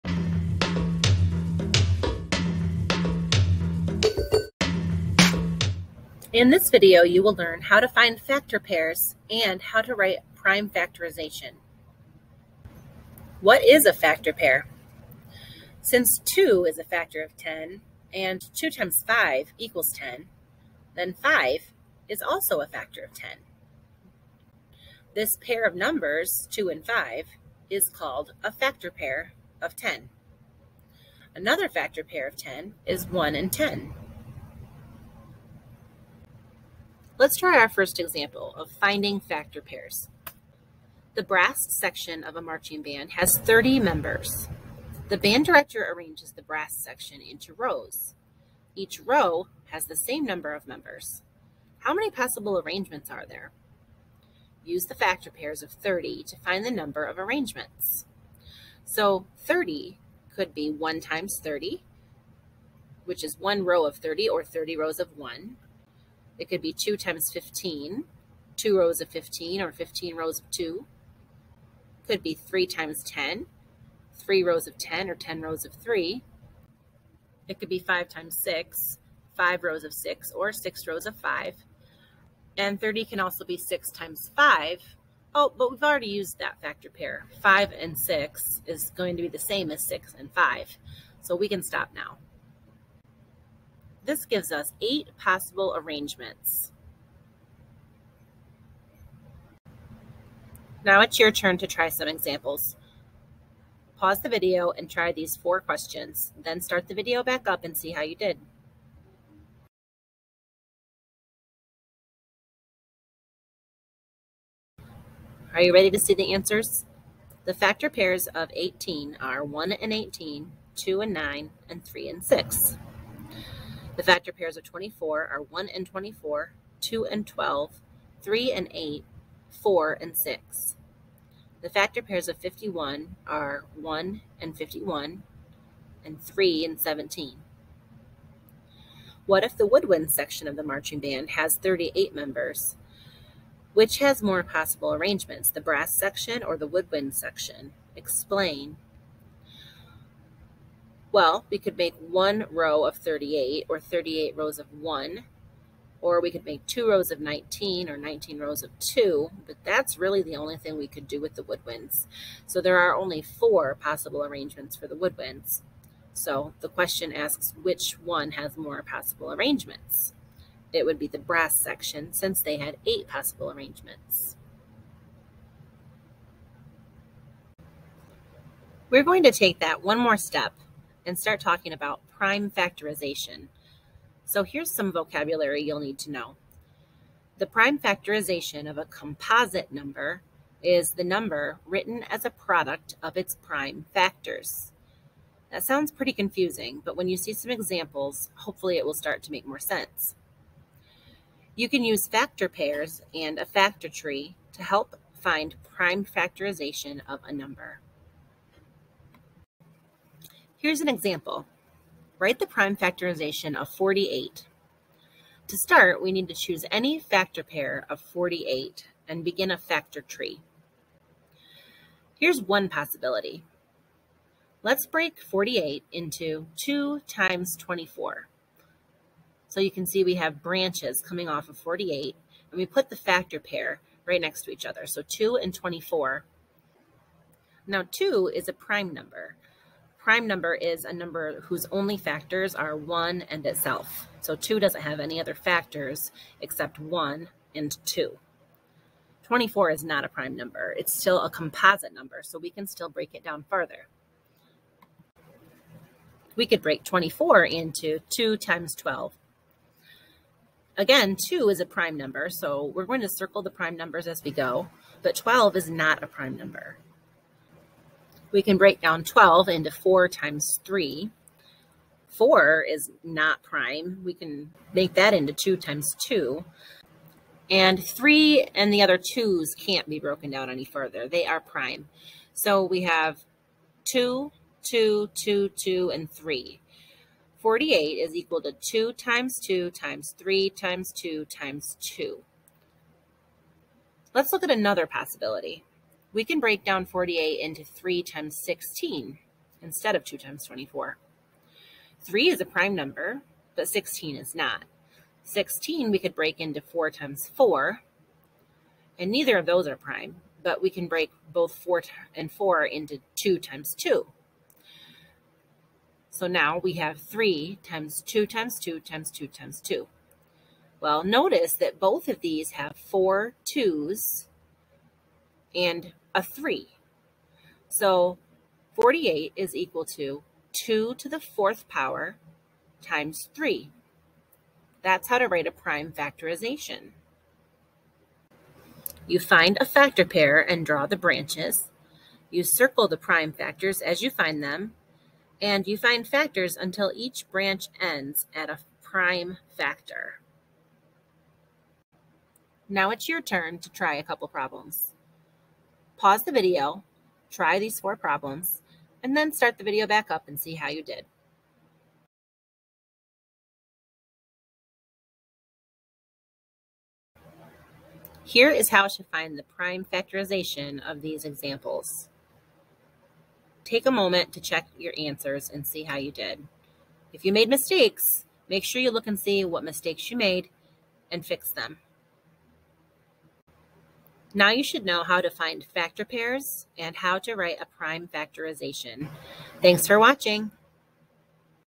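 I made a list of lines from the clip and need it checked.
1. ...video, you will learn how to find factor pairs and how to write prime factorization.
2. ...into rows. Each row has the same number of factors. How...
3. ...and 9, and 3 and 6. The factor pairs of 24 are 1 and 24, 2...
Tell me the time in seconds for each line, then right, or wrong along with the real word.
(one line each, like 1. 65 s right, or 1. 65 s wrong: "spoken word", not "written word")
1. 6 s right
2. 47 s wrong: "members", not "factors"
3. 121 s right.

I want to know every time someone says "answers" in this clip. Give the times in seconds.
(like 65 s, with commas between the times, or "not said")
116 s, 374 s.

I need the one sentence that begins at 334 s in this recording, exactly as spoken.
That's how to write a prime factorization.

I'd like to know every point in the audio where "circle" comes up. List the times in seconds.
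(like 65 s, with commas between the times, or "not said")
263 s, 342 s.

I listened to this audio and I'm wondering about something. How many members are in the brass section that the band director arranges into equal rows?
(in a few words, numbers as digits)
30.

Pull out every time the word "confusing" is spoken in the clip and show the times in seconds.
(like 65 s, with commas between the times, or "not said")
196 s.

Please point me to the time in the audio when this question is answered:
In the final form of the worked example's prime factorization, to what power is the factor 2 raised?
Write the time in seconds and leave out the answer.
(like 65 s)
331 s.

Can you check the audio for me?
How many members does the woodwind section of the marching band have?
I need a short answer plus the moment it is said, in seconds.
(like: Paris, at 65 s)
38, at 141 s.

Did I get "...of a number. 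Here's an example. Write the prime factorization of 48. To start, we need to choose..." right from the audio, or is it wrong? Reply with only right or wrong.
right.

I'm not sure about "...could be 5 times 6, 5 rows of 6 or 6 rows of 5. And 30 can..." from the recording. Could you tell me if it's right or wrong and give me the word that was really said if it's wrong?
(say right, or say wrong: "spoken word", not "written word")
right.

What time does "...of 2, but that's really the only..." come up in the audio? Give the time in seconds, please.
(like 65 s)
158 s.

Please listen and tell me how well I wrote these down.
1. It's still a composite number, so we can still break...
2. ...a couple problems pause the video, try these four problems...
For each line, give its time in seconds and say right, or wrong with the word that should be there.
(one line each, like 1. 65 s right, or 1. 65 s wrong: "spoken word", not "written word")
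1. 250 s right
2. 353 s right.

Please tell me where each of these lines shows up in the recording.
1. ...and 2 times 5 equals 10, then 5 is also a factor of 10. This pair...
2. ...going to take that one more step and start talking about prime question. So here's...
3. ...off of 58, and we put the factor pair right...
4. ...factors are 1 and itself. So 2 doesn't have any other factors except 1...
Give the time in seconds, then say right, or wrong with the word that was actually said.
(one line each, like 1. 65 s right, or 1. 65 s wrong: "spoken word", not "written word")
1. 18 s right
2. 179 s wrong: "factorization", not "question"
3. 231 s wrong: "48", not "58"
4. 241 s right.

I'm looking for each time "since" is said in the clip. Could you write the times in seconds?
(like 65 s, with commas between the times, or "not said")
15 s, 172 s.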